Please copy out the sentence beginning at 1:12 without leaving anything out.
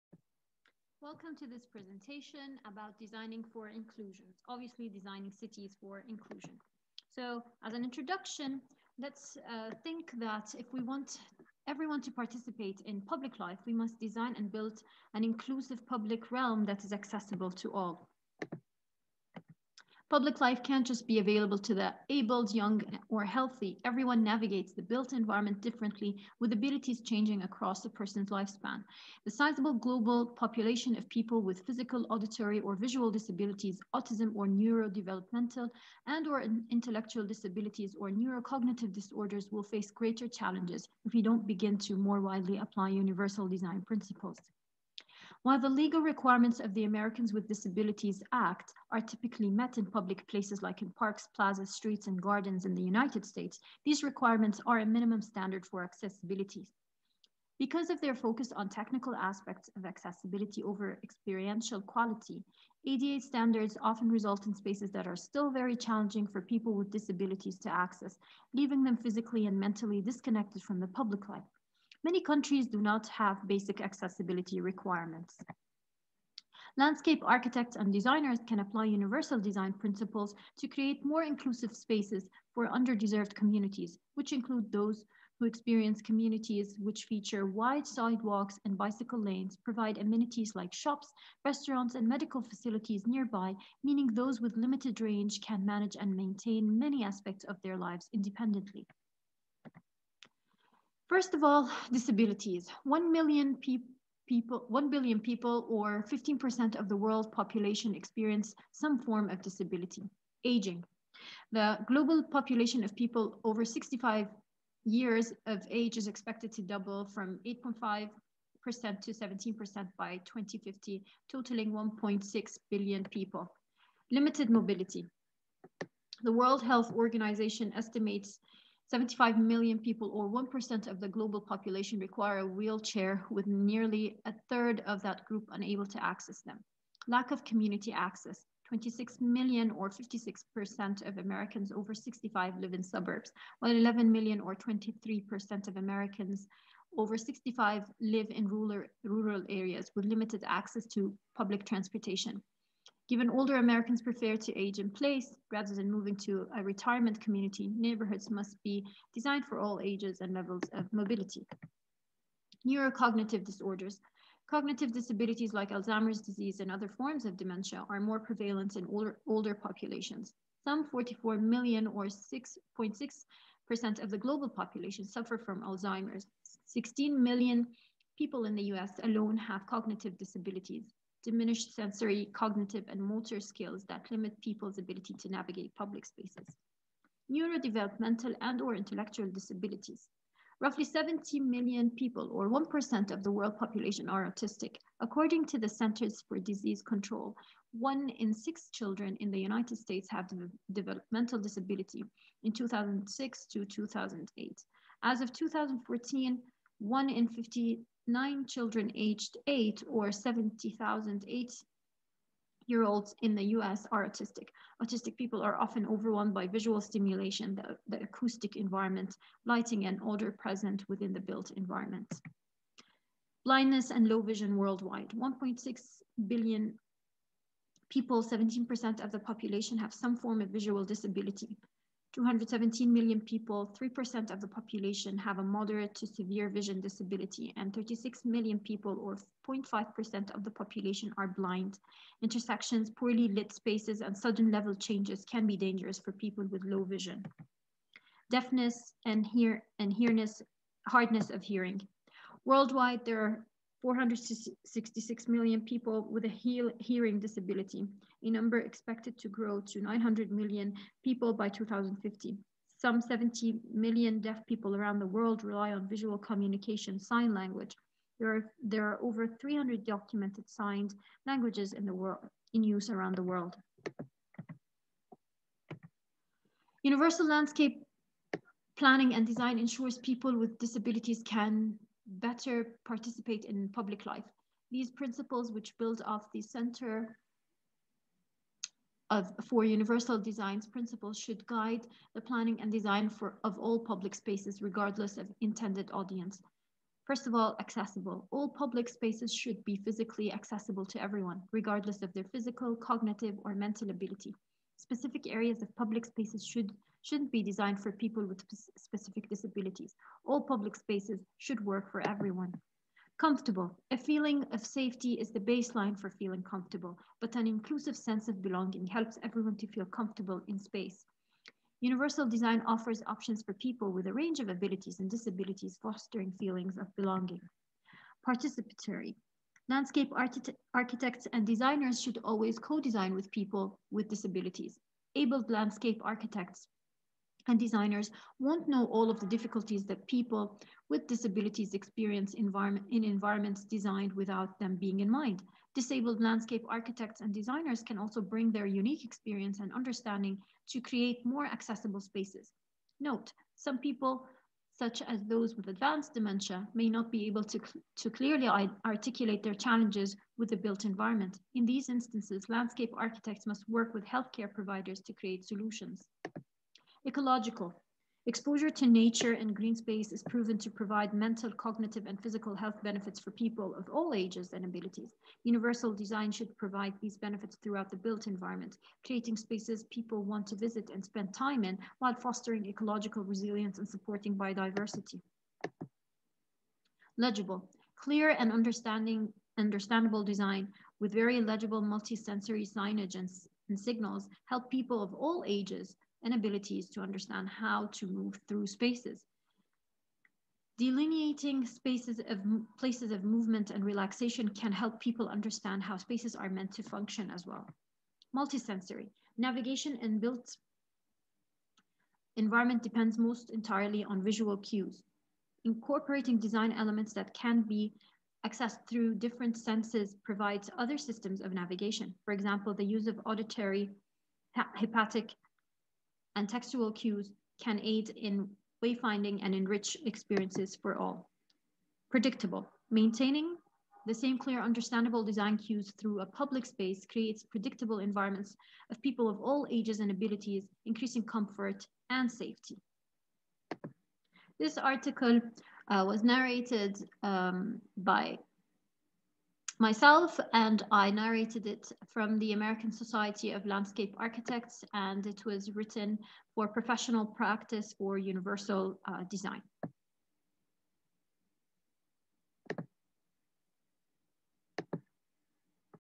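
Many countries do not have basic accessibility requirements.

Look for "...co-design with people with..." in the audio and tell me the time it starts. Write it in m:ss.
5:32.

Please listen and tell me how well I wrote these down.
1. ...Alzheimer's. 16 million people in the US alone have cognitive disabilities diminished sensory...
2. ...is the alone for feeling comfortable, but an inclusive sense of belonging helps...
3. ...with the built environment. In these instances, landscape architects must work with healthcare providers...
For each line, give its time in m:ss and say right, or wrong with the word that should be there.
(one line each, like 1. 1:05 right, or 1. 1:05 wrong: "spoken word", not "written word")
1. 2:55 right
2. 5:15 wrong: "baseline", not "alone"
3. 6:00 right.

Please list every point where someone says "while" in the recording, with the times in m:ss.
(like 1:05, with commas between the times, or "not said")
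0:45, 2:23, 6:21.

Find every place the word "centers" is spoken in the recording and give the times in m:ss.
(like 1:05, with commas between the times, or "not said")
3:15, 4:46.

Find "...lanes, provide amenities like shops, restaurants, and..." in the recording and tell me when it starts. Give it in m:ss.
1:29.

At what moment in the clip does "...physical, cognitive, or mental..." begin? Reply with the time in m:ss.
5:02.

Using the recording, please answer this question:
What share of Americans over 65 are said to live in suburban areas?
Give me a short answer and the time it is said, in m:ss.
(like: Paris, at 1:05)
56%, at 2:19.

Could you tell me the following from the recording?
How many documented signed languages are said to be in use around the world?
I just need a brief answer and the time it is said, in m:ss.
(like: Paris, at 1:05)
over 300, at 4:29.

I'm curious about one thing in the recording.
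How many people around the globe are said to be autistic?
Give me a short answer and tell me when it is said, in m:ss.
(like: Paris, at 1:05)
70 million, at 3:10.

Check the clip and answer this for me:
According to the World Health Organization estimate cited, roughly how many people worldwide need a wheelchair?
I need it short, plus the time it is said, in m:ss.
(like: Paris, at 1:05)
75 million, at 2:08.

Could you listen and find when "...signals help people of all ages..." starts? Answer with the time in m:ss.
6:33.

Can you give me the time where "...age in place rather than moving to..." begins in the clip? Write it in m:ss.
2:34.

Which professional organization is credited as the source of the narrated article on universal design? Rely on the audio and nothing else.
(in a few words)
American Society of Landscape Architects.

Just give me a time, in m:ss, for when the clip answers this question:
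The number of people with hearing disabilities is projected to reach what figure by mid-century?
4:19.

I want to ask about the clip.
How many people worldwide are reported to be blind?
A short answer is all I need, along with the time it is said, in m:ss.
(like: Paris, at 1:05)
36 million, at 3:57.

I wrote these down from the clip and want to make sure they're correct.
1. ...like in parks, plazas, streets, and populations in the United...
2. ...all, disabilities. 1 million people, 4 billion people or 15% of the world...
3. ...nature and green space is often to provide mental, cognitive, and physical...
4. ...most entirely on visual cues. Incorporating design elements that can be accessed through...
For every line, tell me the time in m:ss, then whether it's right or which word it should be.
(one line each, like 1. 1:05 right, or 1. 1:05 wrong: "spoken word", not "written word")
1. 0:50 wrong: "gardens", not "populations"
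2. 1:41 wrong: "1", not "4"
3. 6:08 wrong: "proven", not "often"
4. 6:53 right.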